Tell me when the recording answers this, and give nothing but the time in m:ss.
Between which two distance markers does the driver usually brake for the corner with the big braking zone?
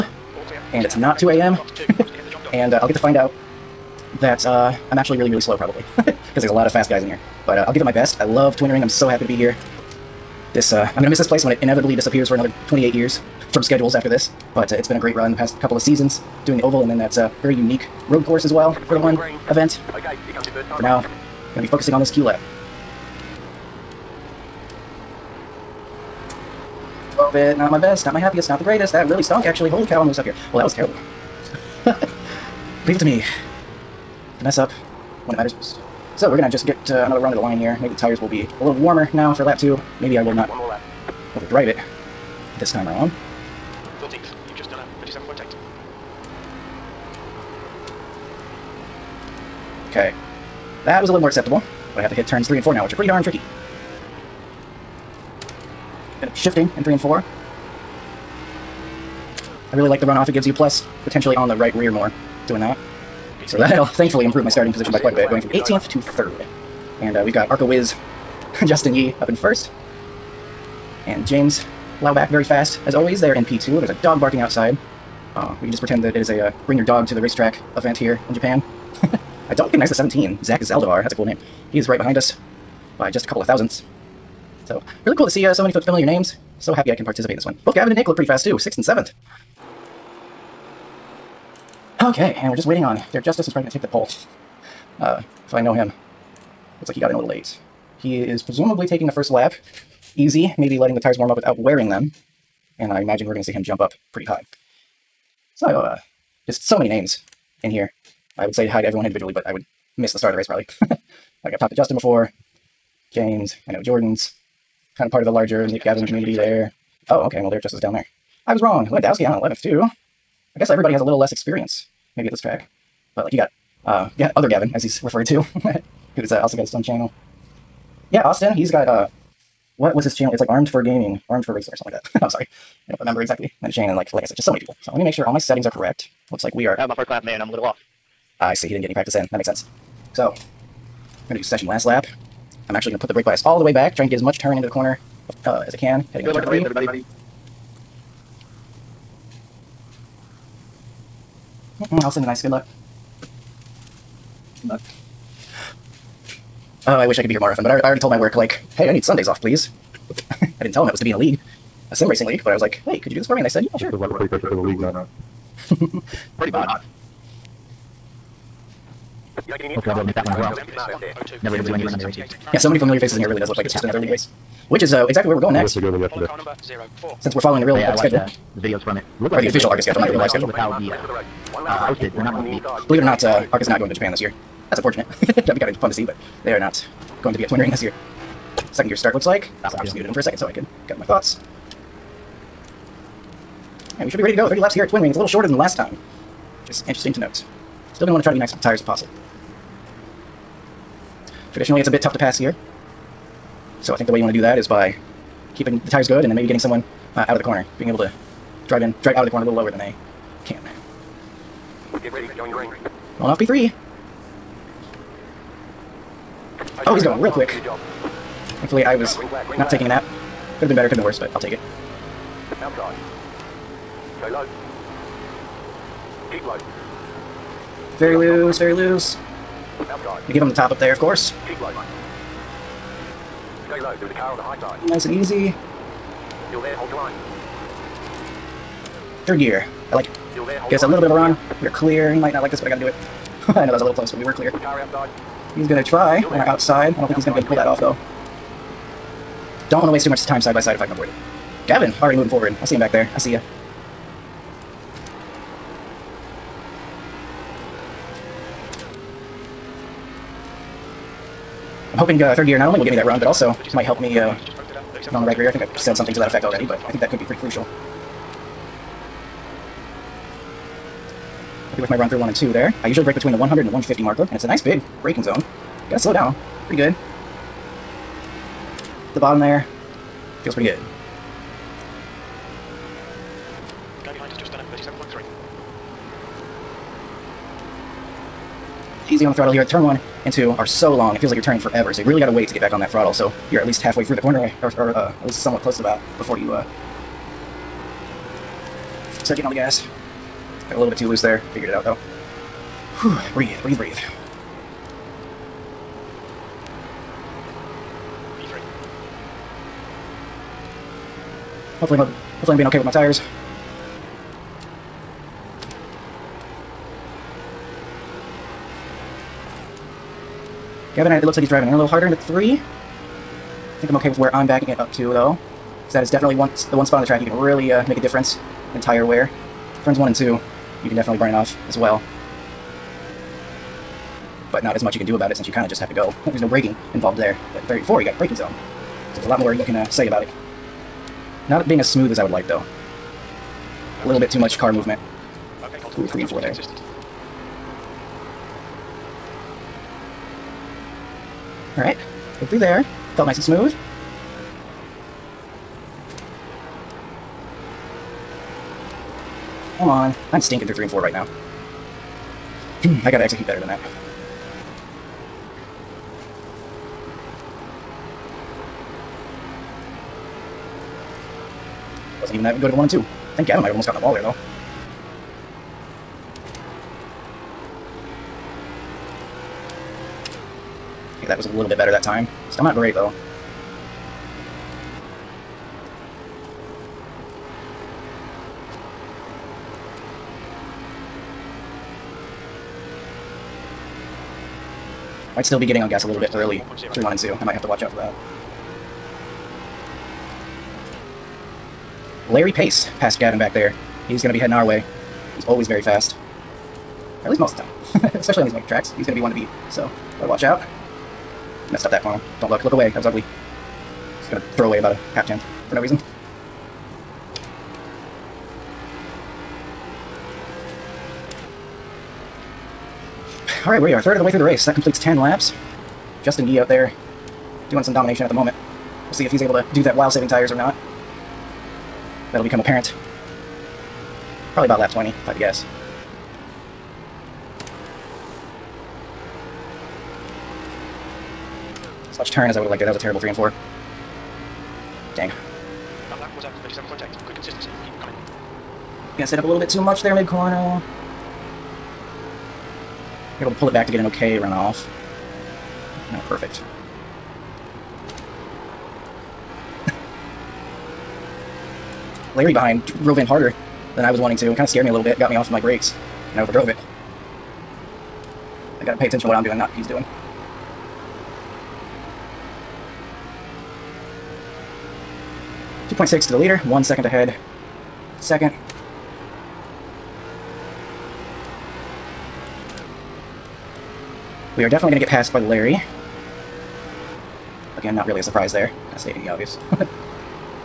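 4:33.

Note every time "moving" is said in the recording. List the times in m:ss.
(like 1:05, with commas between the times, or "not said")
4:12.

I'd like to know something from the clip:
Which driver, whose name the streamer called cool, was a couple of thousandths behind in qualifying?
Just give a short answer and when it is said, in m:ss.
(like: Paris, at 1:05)
Zach Zaldivar, at 1:20.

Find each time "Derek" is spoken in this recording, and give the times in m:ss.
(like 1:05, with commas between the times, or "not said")
1:33, 1:57.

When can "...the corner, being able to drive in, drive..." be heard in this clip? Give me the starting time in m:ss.
3:27.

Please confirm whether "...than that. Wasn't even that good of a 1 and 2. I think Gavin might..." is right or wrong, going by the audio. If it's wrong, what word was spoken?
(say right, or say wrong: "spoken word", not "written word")
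right.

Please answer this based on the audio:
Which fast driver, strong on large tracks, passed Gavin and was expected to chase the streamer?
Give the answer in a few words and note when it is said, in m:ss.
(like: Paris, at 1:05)
Larry Pace, at 6:42.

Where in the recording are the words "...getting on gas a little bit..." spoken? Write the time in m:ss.
6:35.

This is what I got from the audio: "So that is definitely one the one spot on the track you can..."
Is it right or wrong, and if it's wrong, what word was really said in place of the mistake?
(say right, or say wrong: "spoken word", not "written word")
right.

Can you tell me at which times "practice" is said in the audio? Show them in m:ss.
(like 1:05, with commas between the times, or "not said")
2:18.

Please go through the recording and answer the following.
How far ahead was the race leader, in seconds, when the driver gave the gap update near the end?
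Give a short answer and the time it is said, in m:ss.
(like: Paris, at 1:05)
2.6, at 7:55.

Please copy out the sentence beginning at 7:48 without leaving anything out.
I gotta pay attention to what I'm doing, not what he's doing.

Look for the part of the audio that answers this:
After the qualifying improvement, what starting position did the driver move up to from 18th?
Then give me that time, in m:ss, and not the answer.
1:05.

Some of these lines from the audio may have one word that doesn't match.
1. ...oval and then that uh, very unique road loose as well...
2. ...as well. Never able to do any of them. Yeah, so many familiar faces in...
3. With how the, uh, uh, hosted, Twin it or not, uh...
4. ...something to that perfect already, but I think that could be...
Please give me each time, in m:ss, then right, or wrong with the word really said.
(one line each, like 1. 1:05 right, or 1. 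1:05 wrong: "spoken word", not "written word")
1. 0:16 wrong: "course", not "loose"
2. 2:50 right
3. 3:00 wrong: "Believe", not "Twin"
4. 4:25 wrong: "effect", not "perfect".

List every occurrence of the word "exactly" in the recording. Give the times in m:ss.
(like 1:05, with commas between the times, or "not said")
2:13, 2:55.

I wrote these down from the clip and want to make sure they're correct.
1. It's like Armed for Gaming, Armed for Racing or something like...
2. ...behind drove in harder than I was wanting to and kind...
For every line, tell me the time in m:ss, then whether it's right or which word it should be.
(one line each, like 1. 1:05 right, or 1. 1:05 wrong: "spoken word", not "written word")
1. 2:10 right
2. 7:42 right.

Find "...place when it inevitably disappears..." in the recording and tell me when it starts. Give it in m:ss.
0:11.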